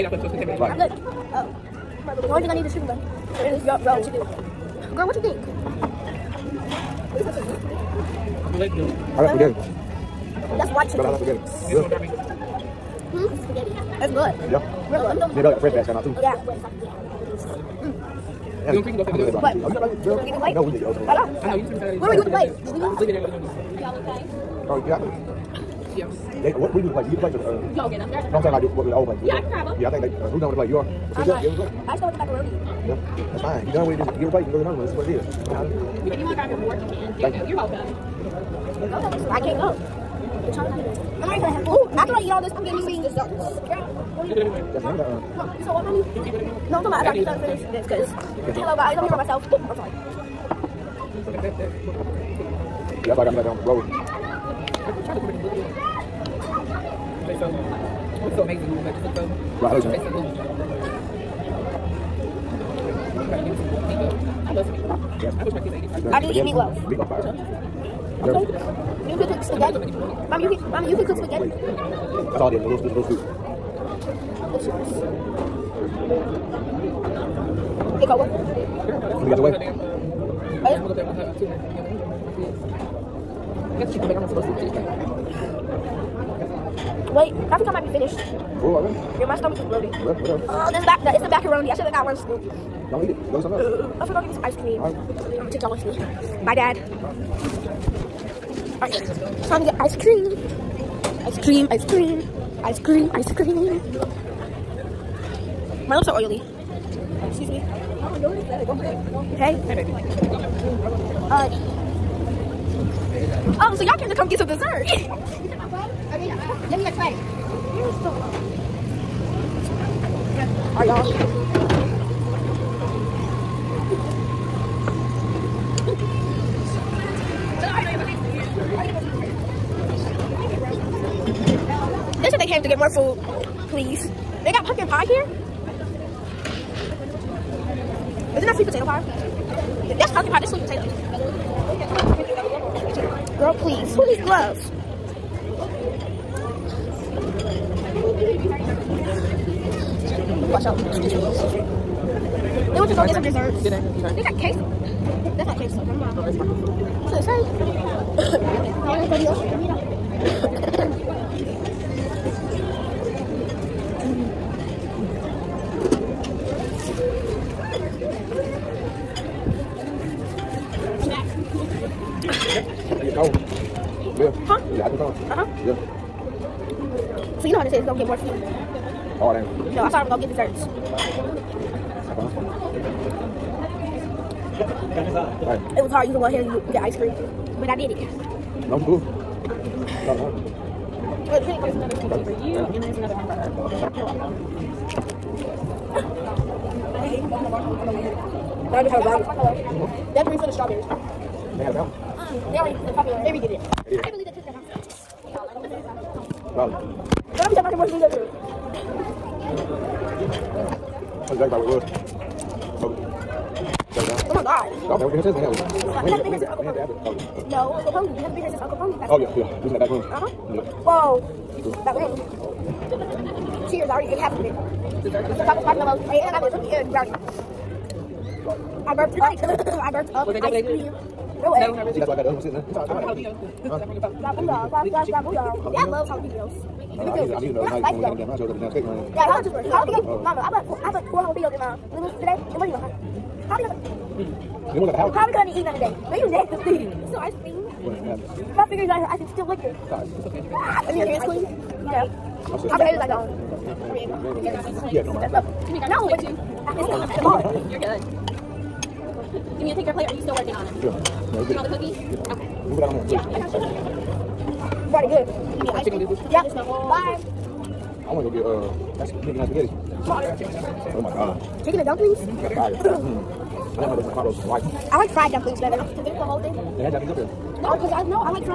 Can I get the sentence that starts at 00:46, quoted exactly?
No, I'm talking about after I get done to finish this, because...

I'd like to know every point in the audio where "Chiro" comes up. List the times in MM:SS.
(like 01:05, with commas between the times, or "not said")
not said.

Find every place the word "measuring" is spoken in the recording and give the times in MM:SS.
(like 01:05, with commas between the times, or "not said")
not said.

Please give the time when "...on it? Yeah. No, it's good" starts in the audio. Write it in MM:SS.
04:20.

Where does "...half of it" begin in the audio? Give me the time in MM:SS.
03:44.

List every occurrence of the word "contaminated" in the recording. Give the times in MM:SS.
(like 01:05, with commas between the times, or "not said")
00:00.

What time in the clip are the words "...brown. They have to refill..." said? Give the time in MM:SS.
03:19.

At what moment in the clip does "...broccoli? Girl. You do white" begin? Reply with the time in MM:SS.
00:19.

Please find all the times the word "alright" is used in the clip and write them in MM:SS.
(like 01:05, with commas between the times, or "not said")
04:09.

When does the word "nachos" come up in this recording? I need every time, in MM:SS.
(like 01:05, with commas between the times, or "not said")
03:58.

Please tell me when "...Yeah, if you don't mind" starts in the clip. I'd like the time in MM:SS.
04:14.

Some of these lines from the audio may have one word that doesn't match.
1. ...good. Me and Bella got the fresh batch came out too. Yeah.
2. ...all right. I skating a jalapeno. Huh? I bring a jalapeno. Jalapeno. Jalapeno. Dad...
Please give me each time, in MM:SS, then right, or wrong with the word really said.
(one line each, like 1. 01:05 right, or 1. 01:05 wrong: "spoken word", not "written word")
1. 00:15 right
2. 03:52 wrong: "bring", not "skating".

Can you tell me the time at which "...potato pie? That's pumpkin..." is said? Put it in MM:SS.
02:18.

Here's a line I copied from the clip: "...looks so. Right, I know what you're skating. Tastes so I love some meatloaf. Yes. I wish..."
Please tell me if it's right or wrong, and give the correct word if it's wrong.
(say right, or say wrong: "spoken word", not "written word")
wrong: "saying", not "skating".